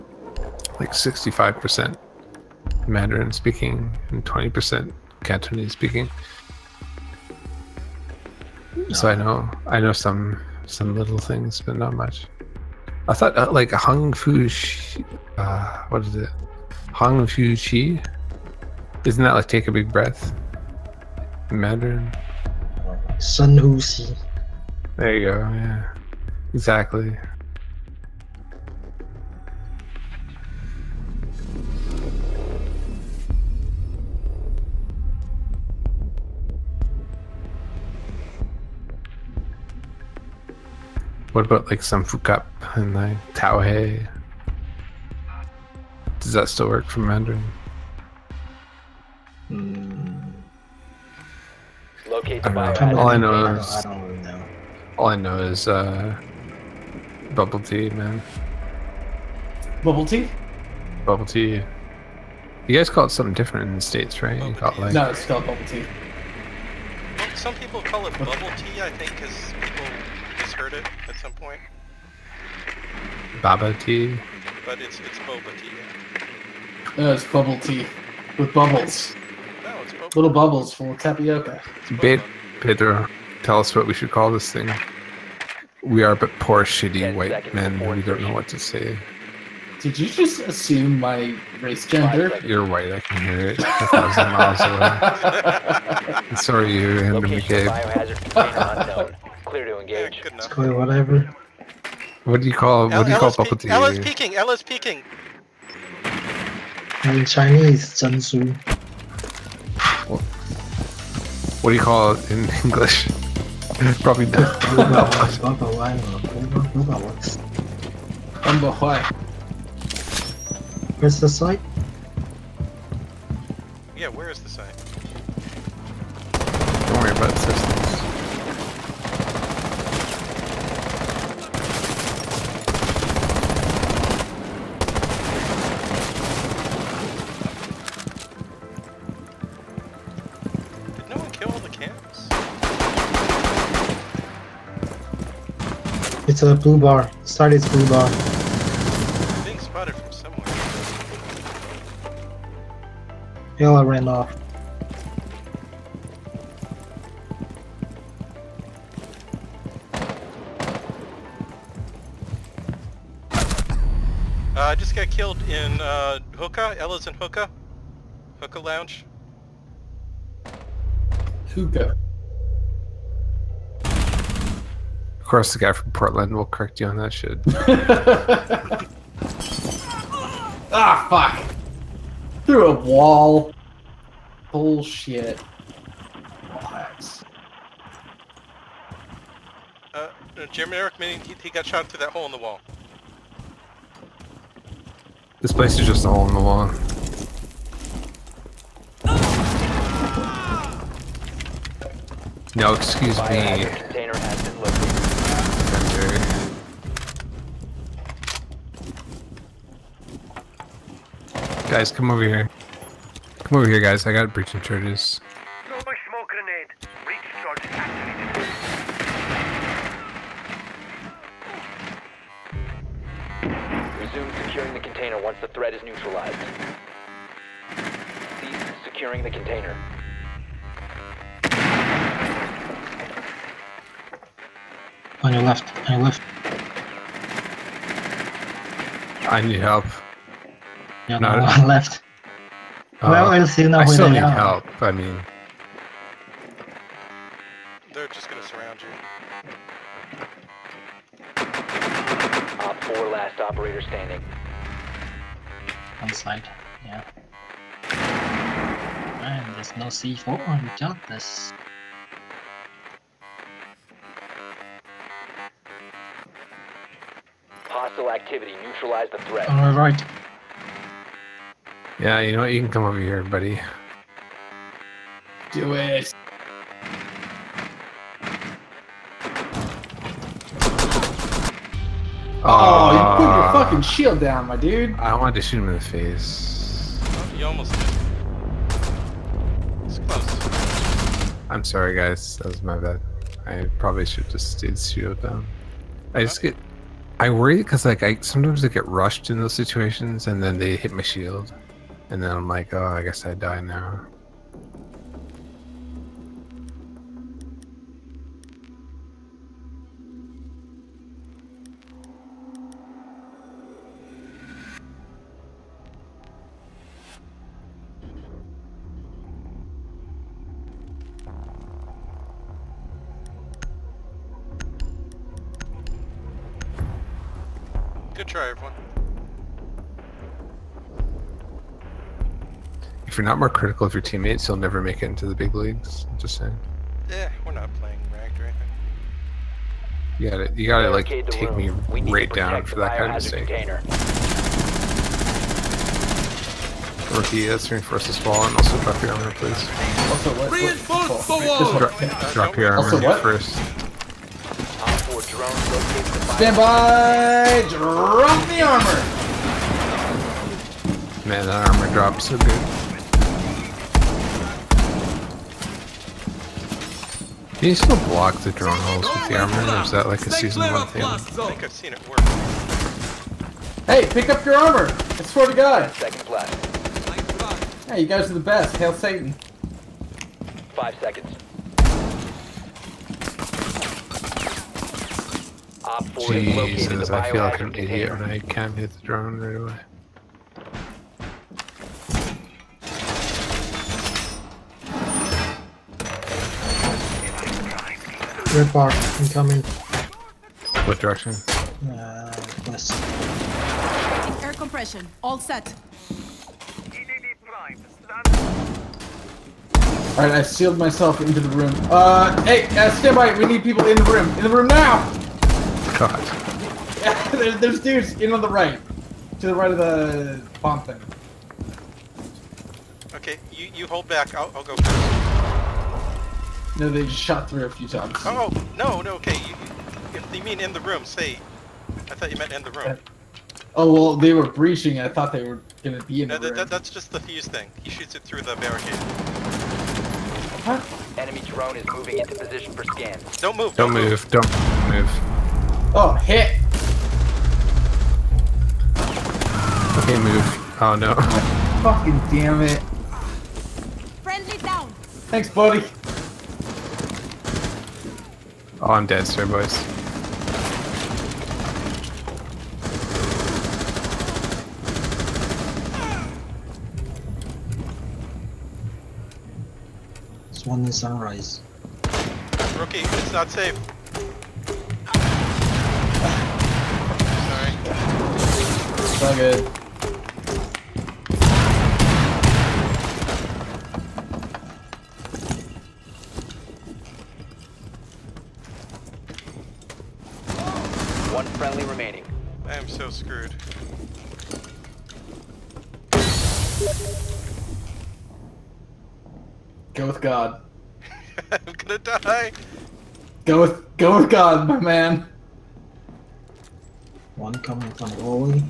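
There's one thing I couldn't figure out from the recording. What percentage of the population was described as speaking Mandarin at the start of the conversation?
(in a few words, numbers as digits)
65%.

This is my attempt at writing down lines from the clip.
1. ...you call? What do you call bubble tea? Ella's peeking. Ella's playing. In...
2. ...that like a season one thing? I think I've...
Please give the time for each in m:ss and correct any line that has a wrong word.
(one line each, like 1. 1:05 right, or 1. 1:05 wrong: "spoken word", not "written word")
1. 1:42 wrong: "peeking", not "playing"
2. 6:09 right.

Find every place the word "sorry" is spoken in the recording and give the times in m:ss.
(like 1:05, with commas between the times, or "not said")
1:36, 4:51, 7:57.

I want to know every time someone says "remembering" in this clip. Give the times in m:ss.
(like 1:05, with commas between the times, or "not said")
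not said.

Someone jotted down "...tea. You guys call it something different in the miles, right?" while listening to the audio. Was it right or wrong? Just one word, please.
wrong.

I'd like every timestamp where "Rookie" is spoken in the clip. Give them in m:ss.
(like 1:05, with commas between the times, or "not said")
5:47, 7:52.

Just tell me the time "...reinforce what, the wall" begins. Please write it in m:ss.
5:50.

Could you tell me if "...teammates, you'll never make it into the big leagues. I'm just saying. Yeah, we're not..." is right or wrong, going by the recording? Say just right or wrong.
right.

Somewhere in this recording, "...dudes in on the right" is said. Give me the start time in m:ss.
6:57.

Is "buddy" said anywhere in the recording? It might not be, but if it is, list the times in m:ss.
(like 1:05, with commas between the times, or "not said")
4:33, 7:35.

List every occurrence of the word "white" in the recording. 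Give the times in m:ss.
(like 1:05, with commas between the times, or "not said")
1:27, 1:32.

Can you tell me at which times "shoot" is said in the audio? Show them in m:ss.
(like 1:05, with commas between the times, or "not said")
4:45, 7:17.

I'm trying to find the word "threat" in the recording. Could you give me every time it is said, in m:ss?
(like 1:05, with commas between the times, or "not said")
3:45, 4:29.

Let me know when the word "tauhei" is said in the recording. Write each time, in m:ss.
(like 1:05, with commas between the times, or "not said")
0:43.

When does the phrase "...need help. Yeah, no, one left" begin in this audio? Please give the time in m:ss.
3:59.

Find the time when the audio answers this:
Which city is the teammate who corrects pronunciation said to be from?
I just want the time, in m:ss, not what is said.
2:55.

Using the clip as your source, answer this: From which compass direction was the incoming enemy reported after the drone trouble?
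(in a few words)
West.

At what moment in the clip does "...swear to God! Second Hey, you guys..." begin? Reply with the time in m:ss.
6:15.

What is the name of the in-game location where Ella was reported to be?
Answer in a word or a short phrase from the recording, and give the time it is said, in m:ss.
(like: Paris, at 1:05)
Hookah Lounge, at 2:48.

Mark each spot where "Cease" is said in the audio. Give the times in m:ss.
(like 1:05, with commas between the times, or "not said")
3:48.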